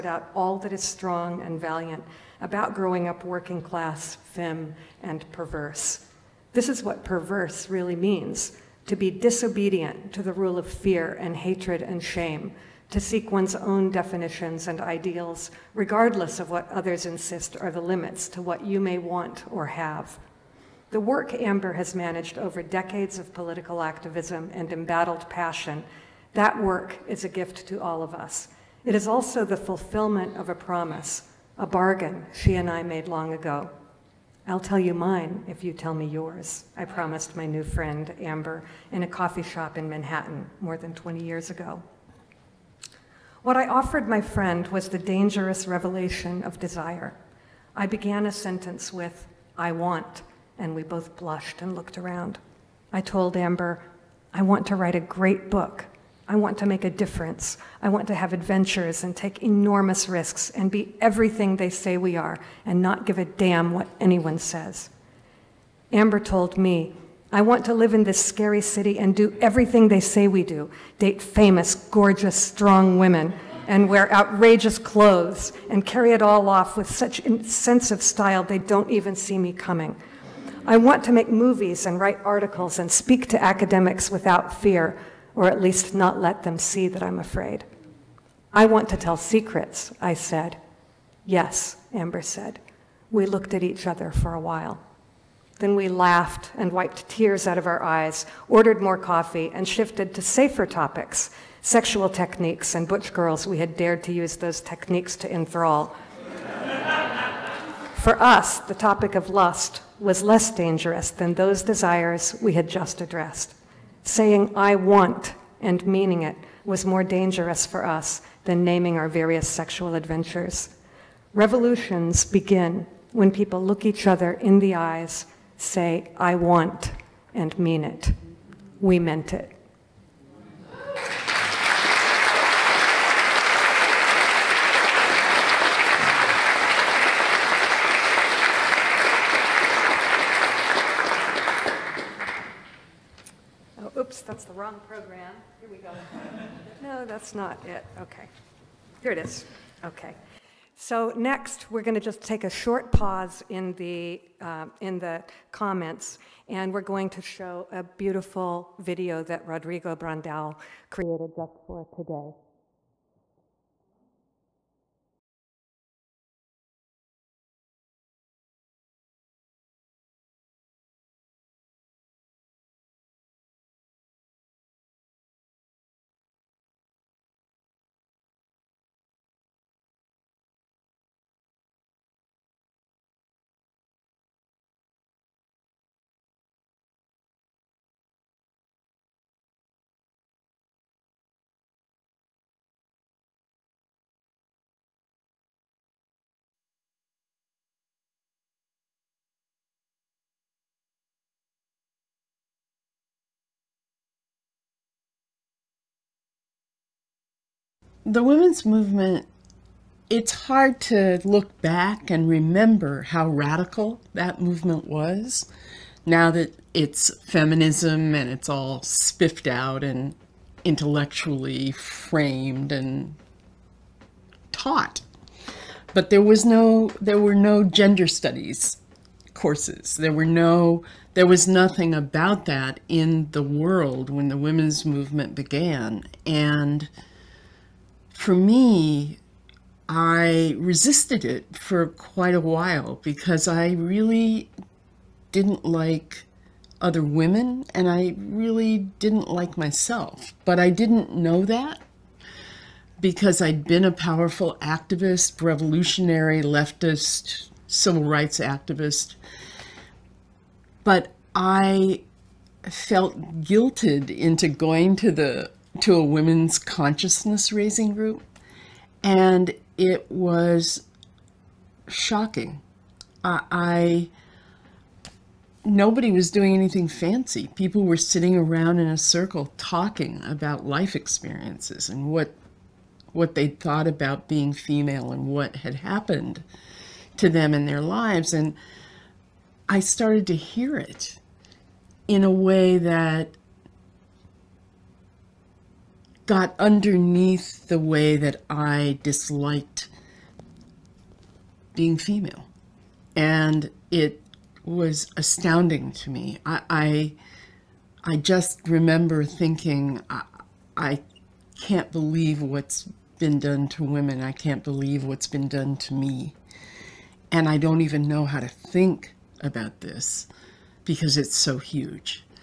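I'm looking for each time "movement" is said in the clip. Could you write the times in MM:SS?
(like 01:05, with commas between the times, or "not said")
03:28, 03:34, 03:54.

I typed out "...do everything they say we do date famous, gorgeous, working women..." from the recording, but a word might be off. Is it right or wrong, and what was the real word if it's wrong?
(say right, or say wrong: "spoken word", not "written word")
wrong: "strong", not "working".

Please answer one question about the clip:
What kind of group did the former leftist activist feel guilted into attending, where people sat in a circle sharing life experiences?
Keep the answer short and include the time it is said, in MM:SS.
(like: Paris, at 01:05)
women's consciousness raising group, at 04:26.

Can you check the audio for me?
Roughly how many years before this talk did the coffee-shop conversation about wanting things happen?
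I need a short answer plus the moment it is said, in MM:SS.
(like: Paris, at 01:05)
more than 20, at 00:40.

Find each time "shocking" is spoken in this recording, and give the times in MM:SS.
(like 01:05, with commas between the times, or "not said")
04:31.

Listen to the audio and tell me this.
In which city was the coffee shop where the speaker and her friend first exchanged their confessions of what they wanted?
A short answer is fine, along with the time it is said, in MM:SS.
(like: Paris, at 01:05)
Manhattan, at 00:39.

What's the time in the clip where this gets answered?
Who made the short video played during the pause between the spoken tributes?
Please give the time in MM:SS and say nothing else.
02:39.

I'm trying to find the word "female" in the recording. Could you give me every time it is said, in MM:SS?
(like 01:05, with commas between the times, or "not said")
04:44, 05:01.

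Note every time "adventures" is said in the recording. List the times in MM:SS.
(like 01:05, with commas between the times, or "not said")
00:58, 01:59.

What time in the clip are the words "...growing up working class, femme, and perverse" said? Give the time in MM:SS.
00:02.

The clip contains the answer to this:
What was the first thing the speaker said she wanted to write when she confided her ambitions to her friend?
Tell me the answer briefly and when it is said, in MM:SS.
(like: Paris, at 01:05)
a great book, at 00:54.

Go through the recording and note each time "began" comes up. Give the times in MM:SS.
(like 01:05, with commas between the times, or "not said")
00:47, 03:55.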